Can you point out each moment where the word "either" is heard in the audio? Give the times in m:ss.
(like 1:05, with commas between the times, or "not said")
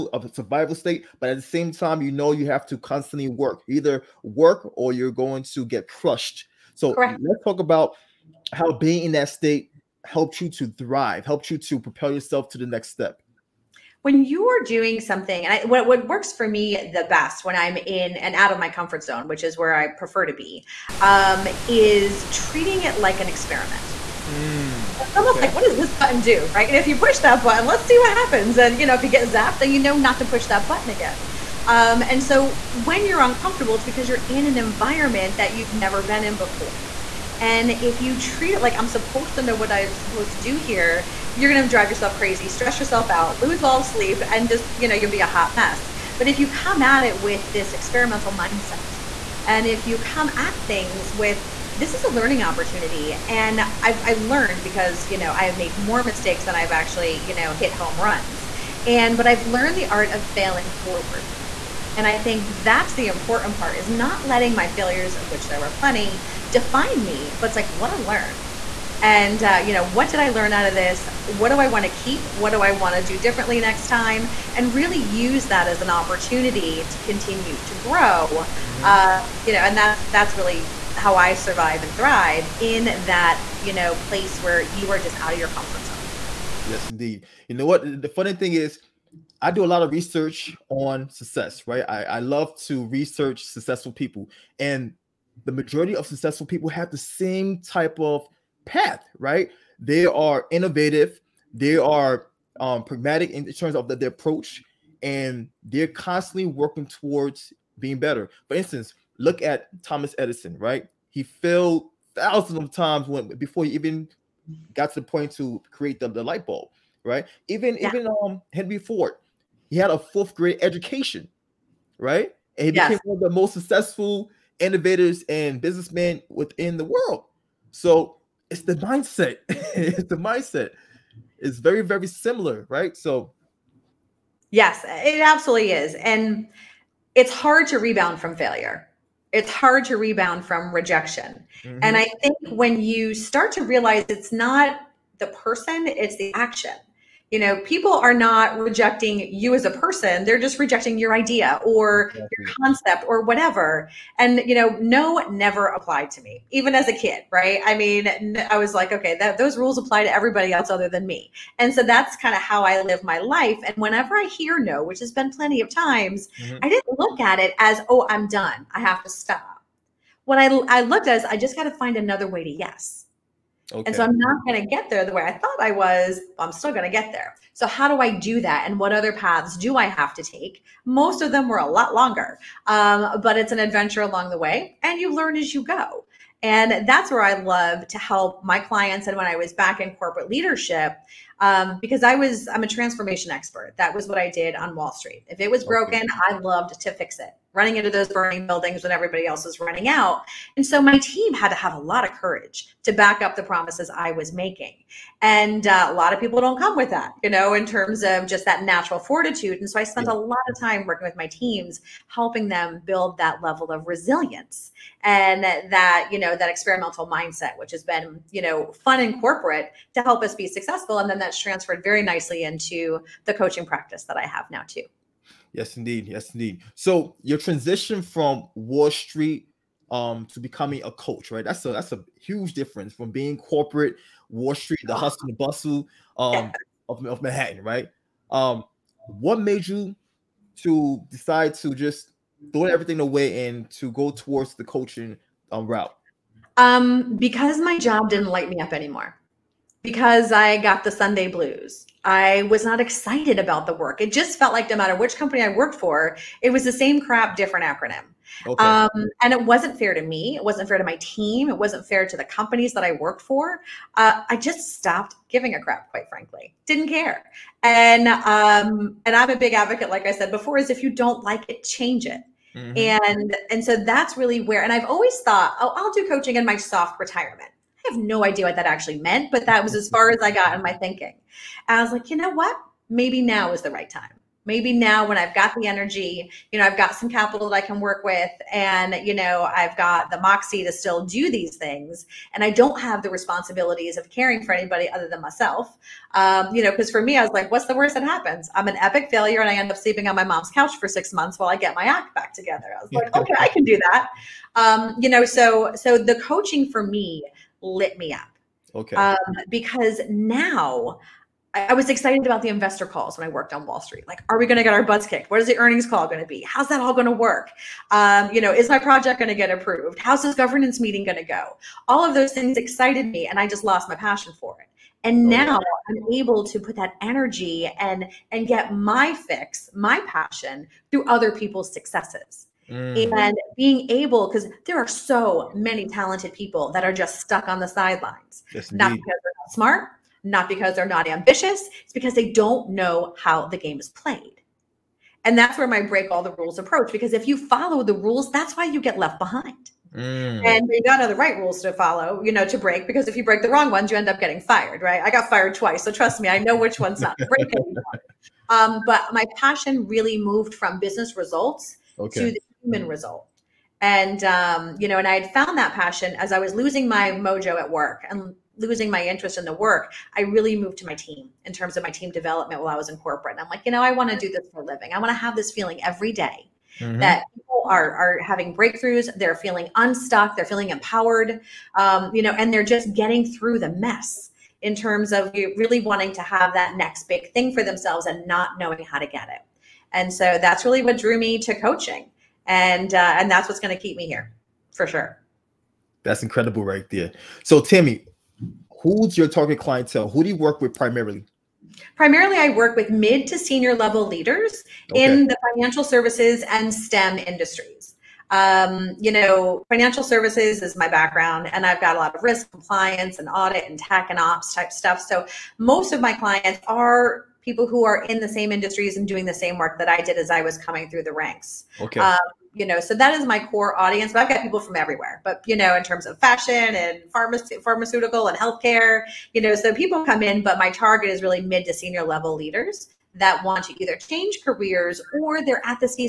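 0:03, 7:13.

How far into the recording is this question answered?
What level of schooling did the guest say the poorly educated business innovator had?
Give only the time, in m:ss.
1:59.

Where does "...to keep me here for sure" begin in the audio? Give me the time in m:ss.
6:33.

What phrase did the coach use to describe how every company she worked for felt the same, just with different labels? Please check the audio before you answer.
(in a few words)
same crap, different acronym.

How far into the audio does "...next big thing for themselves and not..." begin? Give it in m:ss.
6:26.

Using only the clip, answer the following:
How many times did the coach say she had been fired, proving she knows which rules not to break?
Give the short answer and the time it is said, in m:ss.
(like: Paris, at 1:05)
2, at 5:55.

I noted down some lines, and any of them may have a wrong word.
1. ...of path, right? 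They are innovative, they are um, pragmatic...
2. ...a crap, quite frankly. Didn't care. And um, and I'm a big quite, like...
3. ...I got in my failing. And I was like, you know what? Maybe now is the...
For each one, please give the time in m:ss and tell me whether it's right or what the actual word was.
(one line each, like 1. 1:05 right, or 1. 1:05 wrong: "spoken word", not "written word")
1. 1:38 right
2. 4:25 wrong: "advocate", not "quite"
3. 4:40 wrong: "thinking", not "failing".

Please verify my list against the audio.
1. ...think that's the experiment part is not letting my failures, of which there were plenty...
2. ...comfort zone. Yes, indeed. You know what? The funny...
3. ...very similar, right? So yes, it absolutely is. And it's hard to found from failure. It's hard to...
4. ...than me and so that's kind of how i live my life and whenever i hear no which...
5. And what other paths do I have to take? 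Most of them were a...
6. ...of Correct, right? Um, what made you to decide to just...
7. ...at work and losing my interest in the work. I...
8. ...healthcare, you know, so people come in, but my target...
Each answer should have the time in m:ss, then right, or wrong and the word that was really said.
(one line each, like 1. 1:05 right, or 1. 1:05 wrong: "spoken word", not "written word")
1. 1:02 wrong: "important", not "experiment"
2. 1:25 right
3. 2:11 wrong: "rebound", not "found"
4. 2:40 right
5. 2:58 right
6. 3:57 wrong: "Manhattan", not "Correct"
7. 6:07 right
8. 7:08 right.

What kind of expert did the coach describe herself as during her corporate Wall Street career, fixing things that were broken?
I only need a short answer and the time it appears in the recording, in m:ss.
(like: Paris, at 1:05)
transformation expert, at 3:12.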